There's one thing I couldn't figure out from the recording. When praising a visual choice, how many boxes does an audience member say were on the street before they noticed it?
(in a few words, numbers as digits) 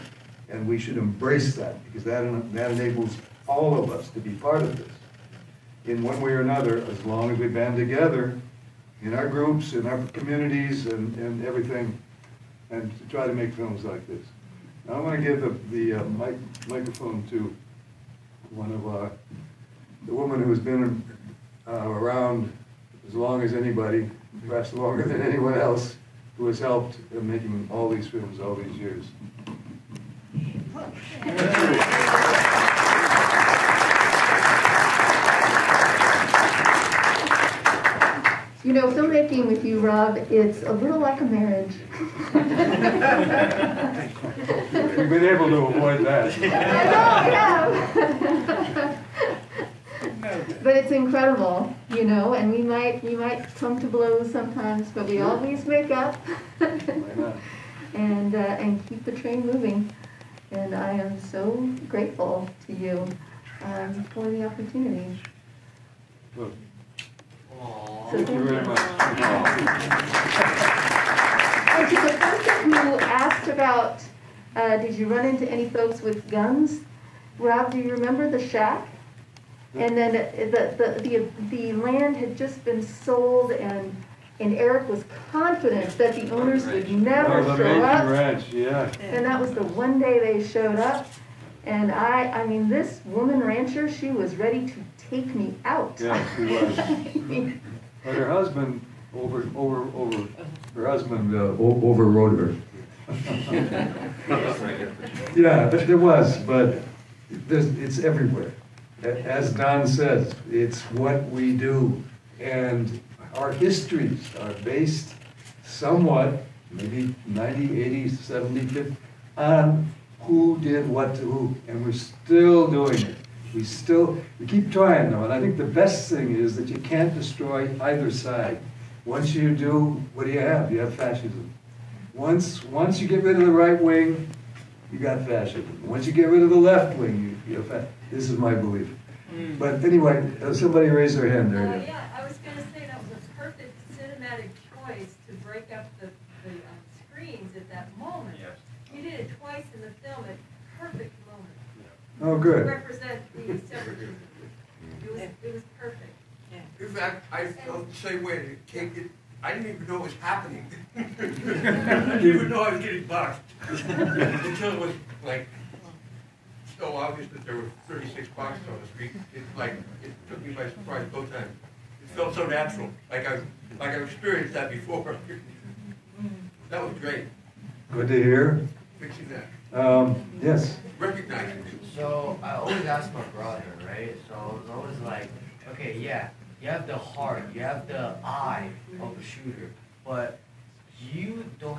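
36.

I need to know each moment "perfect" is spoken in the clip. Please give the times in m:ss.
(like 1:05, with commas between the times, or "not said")
2:23, 2:35.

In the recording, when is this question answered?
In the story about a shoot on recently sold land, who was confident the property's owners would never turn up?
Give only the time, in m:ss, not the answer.
1:24.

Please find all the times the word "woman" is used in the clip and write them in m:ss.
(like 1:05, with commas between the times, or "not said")
0:20, 1:33.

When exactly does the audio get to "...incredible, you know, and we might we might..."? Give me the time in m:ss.
0:50.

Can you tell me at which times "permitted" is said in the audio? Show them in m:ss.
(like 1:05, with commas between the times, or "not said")
not said.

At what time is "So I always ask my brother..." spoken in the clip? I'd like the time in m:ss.
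3:01.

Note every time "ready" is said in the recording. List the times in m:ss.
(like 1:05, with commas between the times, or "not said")
1:34.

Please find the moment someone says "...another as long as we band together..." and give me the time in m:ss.
0:06.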